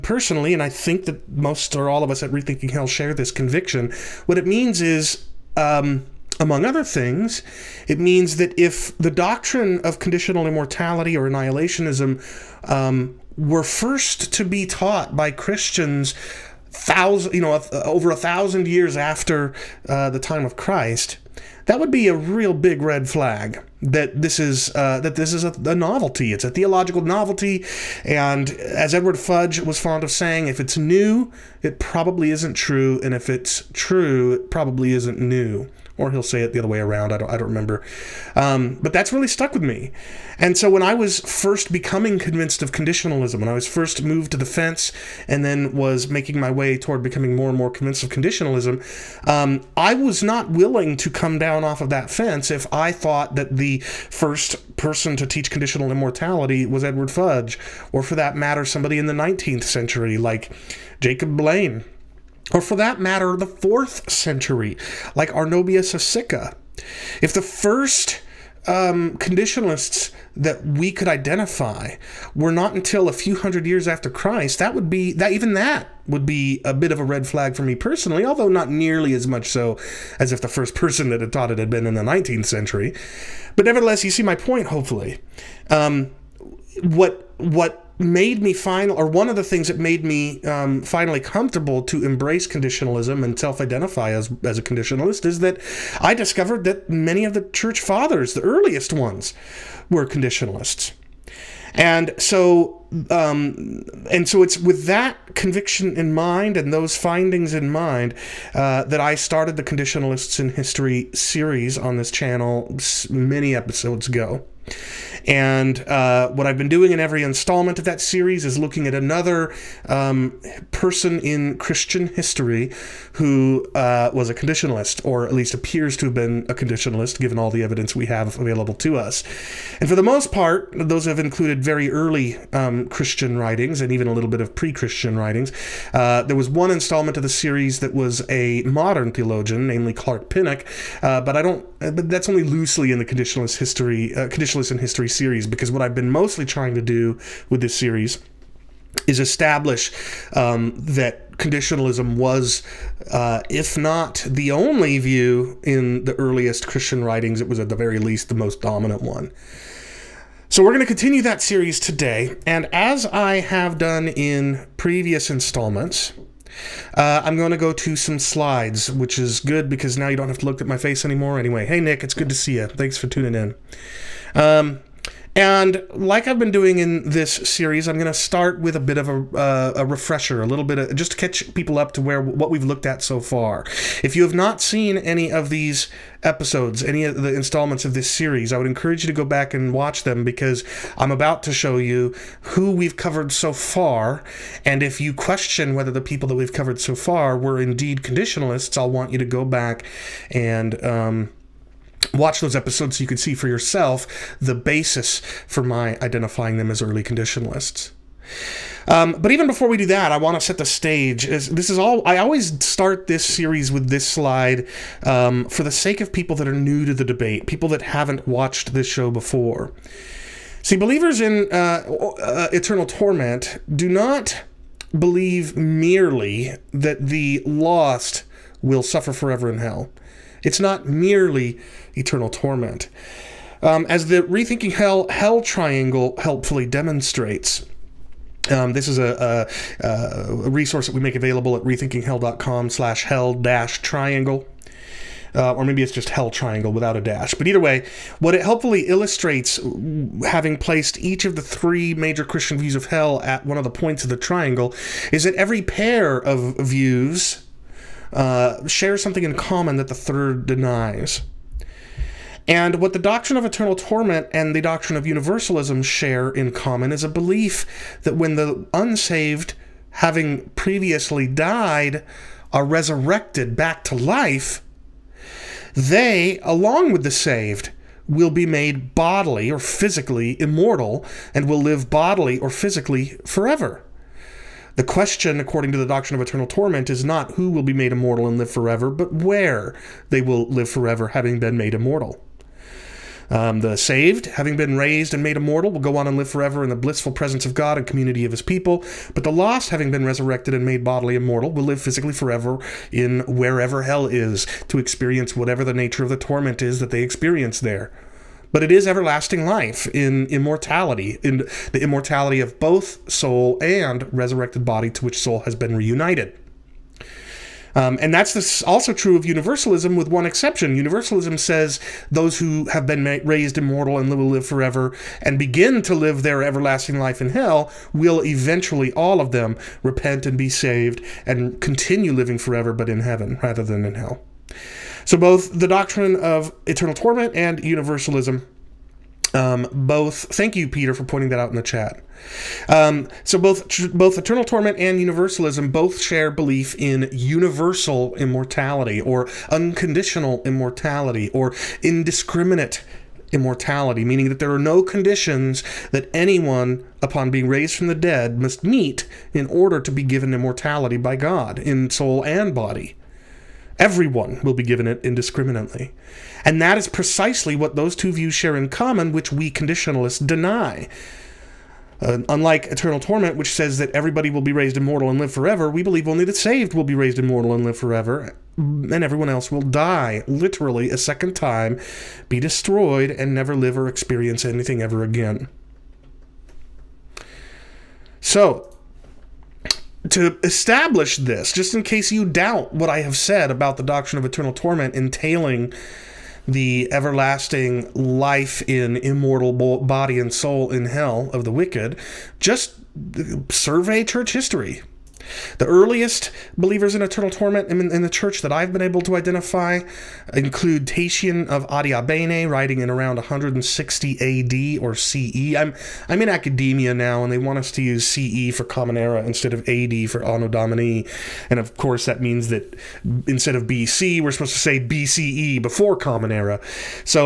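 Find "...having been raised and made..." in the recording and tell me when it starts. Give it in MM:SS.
04:54.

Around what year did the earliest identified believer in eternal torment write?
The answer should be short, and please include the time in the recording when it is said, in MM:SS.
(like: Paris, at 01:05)
160, at 06:53.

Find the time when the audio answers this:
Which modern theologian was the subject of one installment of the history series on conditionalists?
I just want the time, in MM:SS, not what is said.
02:19.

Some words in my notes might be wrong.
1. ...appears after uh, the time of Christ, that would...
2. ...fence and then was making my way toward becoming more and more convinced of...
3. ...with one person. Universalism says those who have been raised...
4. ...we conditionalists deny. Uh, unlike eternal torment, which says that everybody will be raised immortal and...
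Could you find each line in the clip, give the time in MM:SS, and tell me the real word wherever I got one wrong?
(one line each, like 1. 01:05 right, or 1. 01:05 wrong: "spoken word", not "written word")
1. 00:18 wrong: "years", not "appears"
2. 00:44 right
3. 05:19 wrong: "exception", not "person"
4. 06:09 right.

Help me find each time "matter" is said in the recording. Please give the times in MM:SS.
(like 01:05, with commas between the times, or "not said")
00:58, 01:02.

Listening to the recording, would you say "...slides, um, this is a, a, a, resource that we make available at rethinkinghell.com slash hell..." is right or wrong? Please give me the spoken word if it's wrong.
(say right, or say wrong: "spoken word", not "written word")
wrong: "demonstrates", not "slides".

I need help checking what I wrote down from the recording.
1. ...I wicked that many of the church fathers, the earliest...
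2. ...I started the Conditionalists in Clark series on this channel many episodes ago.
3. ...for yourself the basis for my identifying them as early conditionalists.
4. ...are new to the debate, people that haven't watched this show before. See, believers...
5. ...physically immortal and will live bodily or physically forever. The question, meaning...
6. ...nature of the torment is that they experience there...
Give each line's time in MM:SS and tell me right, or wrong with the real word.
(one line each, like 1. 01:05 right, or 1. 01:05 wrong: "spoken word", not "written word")
1. 01:35 wrong: "discovered", not "wicked"
2. 01:49 wrong: "History", not "Clark"
3. 03:23 right
4. 03:36 right
5. 04:39 wrong: "according", not "meaning"
6. 05:05 right.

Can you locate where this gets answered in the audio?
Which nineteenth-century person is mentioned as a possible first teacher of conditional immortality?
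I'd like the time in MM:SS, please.
01:00.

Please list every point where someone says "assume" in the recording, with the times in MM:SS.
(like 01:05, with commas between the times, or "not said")
not said.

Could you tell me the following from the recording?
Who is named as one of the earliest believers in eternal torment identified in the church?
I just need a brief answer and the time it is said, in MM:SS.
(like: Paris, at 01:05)
Tatian of Adiabene, at 06:50.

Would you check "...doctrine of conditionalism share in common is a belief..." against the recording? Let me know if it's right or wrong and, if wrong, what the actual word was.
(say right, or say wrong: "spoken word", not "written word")
wrong: "universalism", not "conditionalism".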